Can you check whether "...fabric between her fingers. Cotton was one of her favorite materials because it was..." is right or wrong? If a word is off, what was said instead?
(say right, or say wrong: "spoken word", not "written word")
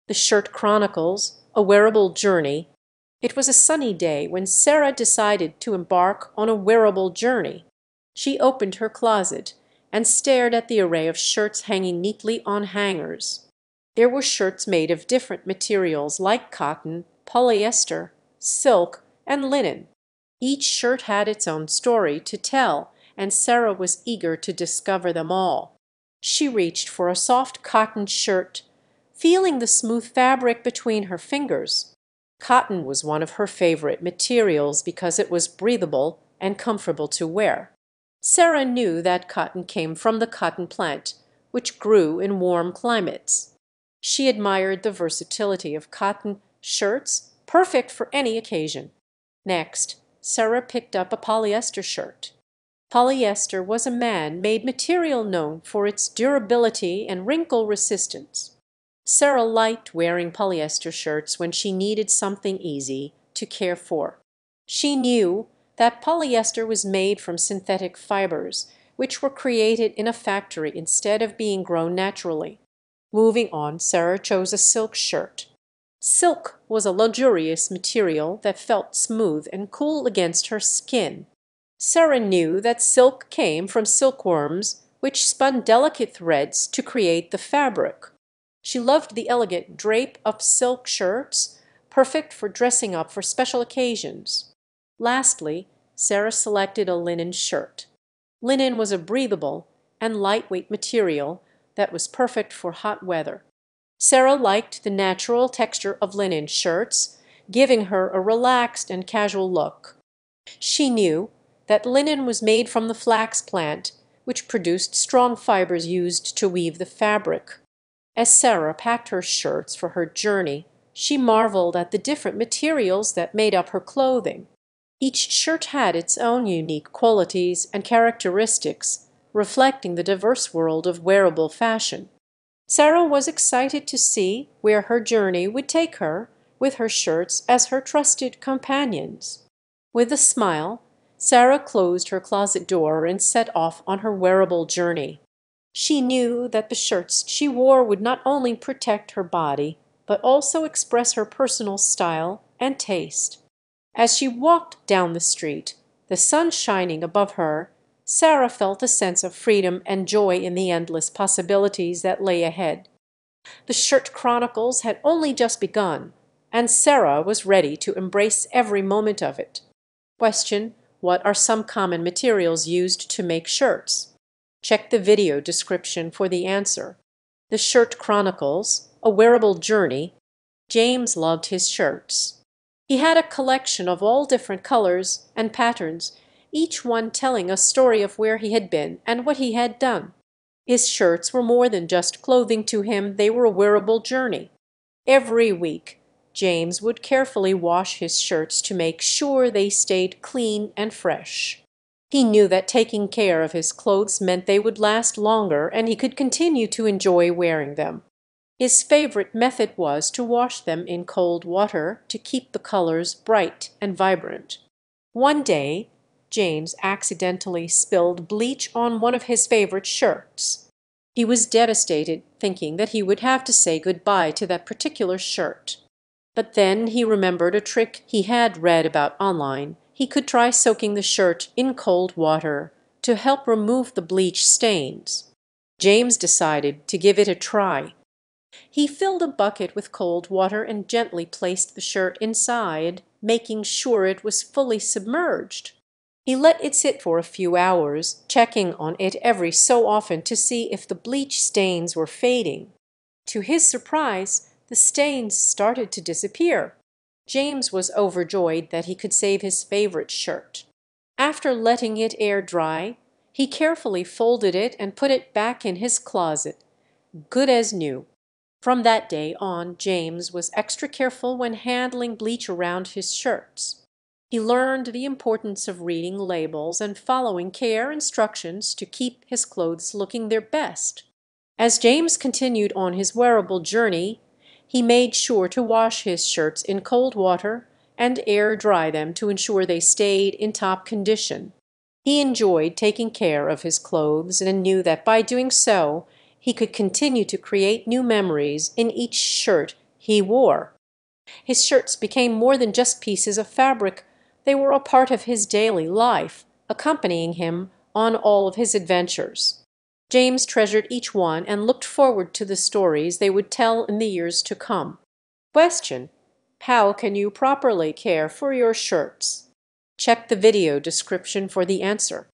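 right.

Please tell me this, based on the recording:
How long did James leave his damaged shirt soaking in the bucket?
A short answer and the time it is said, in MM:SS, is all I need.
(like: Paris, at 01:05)
a few hours, at 04:07.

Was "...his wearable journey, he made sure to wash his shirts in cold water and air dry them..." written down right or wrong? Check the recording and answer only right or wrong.
right.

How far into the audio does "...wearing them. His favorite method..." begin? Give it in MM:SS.
03:27.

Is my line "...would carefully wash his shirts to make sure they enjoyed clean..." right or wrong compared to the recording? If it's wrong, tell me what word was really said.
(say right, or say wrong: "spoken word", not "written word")
wrong: "stayed", not "enjoyed".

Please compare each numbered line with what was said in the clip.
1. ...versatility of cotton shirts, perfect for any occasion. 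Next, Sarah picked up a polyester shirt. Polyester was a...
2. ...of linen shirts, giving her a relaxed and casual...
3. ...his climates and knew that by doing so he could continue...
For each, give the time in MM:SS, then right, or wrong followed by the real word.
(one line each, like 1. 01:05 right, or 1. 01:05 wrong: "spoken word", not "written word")
1. 00:44 right
2. 01:46 right
3. 04:53 wrong: "clothes", not "climates".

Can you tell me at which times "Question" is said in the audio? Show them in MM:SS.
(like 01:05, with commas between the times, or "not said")
02:50, 05:15.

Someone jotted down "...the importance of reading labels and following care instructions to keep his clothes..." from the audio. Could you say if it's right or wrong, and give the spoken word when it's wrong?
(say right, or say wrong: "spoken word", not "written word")
right.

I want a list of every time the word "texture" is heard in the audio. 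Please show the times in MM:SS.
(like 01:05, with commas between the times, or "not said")
01:45.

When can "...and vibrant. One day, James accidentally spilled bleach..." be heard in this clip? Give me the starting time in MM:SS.
03:33.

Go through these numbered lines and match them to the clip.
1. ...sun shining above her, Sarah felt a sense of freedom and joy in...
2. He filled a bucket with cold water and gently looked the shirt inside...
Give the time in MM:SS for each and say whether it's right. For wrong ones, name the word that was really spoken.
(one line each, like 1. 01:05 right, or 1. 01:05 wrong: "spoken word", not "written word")
1. 02:36 right
2. 03:58 wrong: "placed", not "looked".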